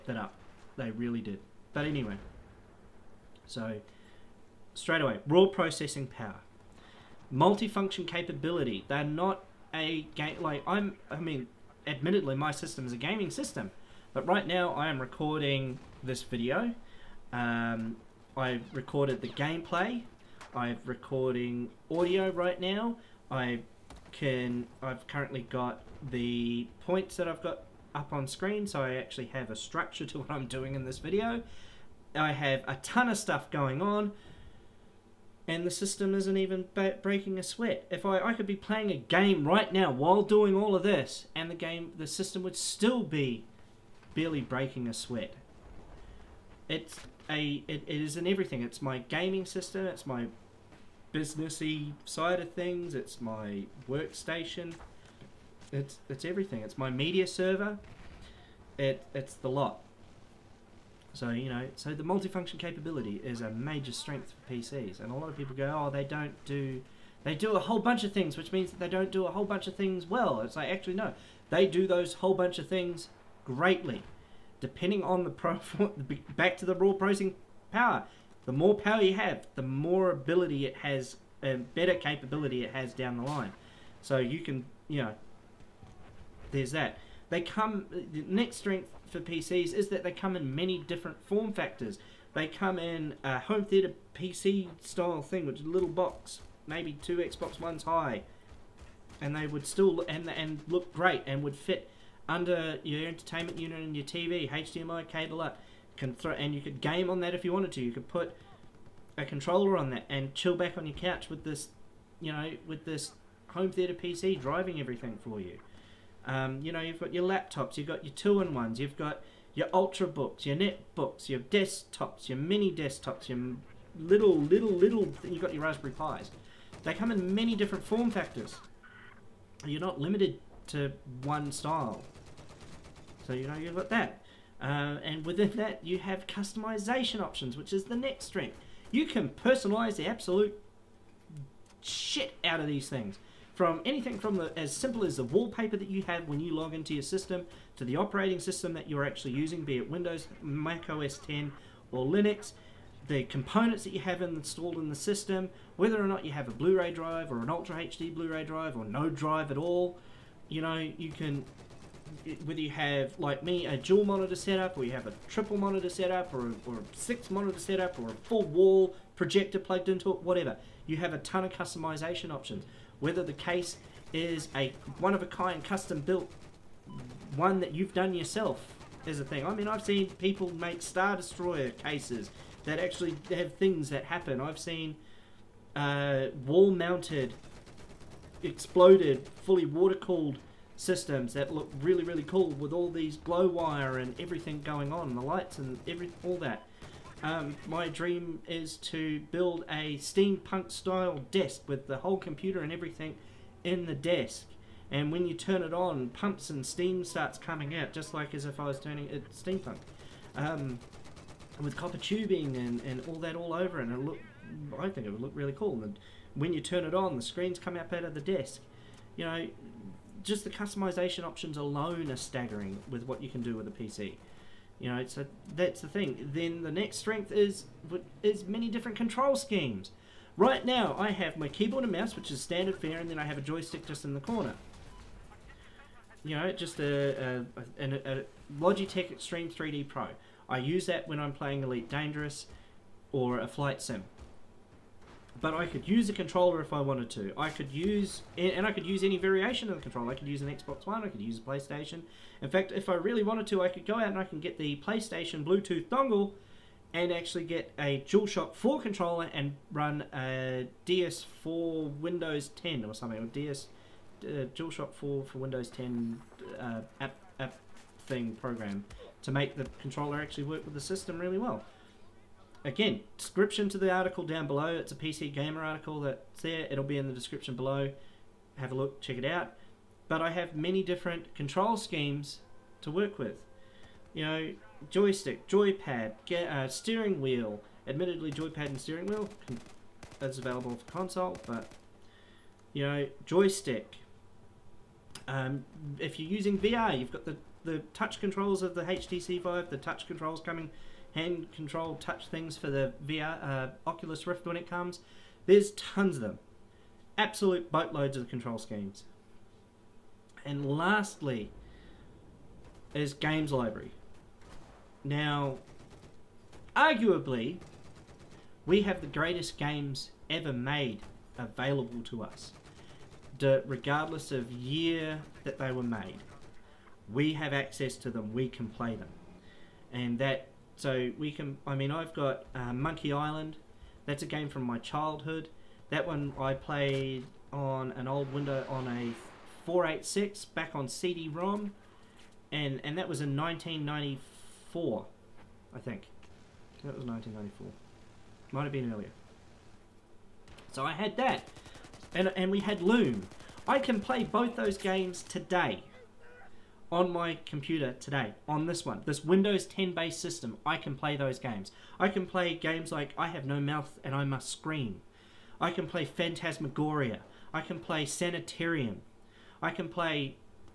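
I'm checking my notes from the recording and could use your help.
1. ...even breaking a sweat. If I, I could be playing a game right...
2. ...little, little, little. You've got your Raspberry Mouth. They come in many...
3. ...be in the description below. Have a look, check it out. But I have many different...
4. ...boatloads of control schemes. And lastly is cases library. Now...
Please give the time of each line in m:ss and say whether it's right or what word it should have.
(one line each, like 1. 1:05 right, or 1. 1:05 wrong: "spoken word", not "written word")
1. 0:36 right
2. 2:03 wrong: "Pis", not "Mouth"
3. 4:36 right
4. 5:07 wrong: "games", not "cases".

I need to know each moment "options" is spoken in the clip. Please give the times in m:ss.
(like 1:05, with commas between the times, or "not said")
2:17, 2:52, 3:41.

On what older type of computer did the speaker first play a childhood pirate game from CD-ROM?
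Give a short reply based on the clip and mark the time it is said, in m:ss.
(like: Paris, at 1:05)
486, at 5:39.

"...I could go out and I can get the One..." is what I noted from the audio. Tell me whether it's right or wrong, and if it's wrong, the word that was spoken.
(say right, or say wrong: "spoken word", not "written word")
wrong: "PlayStation", not "One".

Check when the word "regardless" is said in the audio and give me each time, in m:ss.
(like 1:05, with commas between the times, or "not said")
5:23.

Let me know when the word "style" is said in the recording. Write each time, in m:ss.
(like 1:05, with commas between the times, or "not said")
1:34, 2:11, 3:20.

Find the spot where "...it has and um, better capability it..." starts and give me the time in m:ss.
1:20.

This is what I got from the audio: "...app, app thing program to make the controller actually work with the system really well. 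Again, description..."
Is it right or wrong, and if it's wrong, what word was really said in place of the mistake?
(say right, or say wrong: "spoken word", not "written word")
right.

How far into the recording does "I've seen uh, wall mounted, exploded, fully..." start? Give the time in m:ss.
3:04.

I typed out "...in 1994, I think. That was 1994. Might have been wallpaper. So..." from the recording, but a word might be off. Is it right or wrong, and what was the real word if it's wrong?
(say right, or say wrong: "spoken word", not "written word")
wrong: "earlier", not "wallpaper".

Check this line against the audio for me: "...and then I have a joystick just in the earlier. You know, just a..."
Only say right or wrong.
wrong.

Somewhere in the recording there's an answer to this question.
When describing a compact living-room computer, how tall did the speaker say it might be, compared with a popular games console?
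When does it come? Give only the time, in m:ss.
1:37.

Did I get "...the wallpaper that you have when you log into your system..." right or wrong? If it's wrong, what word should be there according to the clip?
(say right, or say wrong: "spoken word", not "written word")
right.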